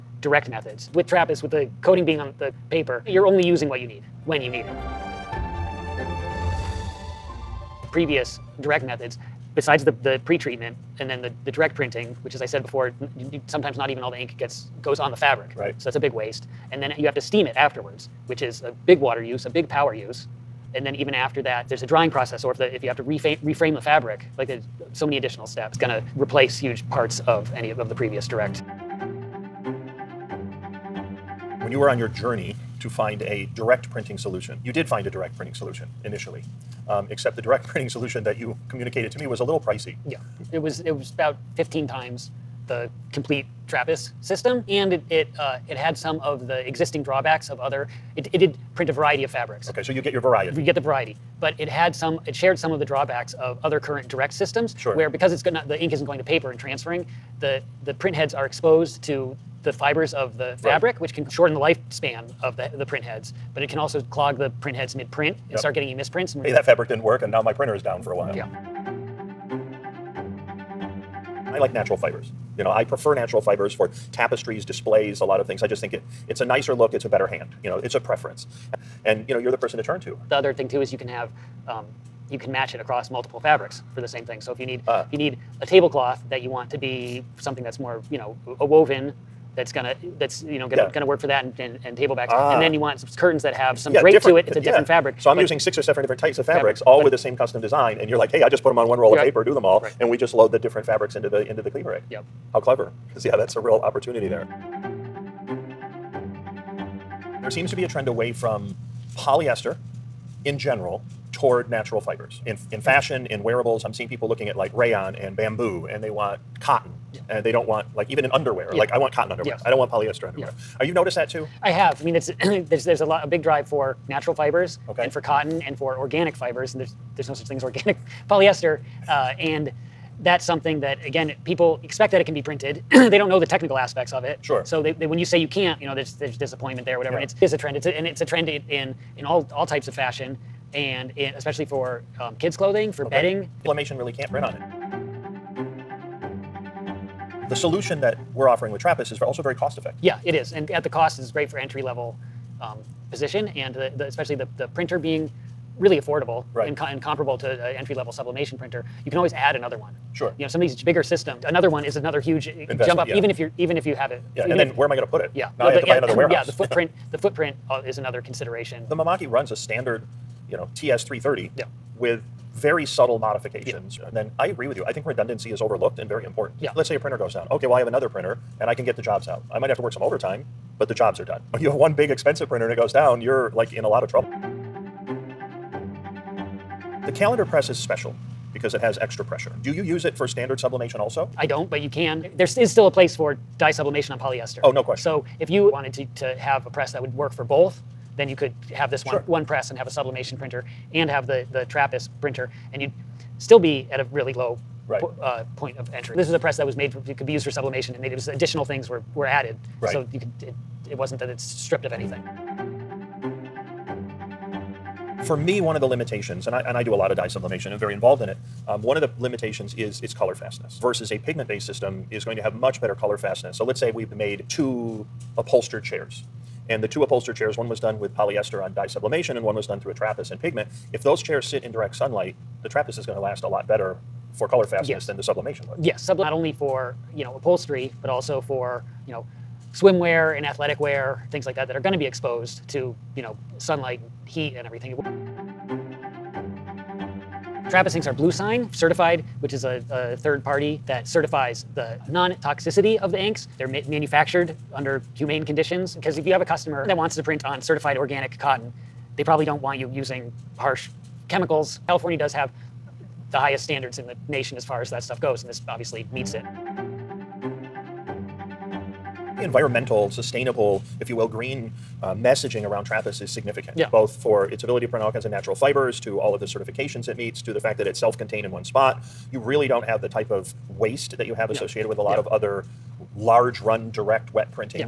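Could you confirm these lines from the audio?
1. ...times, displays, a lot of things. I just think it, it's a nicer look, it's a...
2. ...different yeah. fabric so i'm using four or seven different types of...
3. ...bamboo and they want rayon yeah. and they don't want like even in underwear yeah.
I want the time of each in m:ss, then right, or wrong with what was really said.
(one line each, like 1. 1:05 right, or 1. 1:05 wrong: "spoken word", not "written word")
1. 1:14 wrong: "tapestries", not "times"
2. 1:34 wrong: "six", not "four"
3. 1:55 wrong: "cotton", not "rayon".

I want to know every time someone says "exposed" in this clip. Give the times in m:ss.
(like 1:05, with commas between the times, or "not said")
0:58, 4:02.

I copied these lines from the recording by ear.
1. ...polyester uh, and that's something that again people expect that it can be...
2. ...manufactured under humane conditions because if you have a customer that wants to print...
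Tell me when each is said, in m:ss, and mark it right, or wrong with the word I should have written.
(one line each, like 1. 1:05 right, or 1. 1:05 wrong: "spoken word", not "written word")
1. 2:08 right
2. 4:13 right.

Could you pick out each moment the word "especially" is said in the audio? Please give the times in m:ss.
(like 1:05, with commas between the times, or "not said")
2:21, 2:34.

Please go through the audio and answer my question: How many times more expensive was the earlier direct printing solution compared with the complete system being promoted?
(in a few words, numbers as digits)
15 times.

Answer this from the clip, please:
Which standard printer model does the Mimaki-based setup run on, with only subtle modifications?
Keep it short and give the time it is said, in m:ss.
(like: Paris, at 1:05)
TS 330, at 2:50.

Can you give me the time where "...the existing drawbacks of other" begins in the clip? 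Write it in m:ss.
0:46.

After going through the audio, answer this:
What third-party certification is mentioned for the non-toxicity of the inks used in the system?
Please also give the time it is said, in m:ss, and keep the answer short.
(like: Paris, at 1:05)
bluesign, at 4:08.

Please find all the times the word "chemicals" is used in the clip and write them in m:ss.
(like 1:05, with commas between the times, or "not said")
4:21.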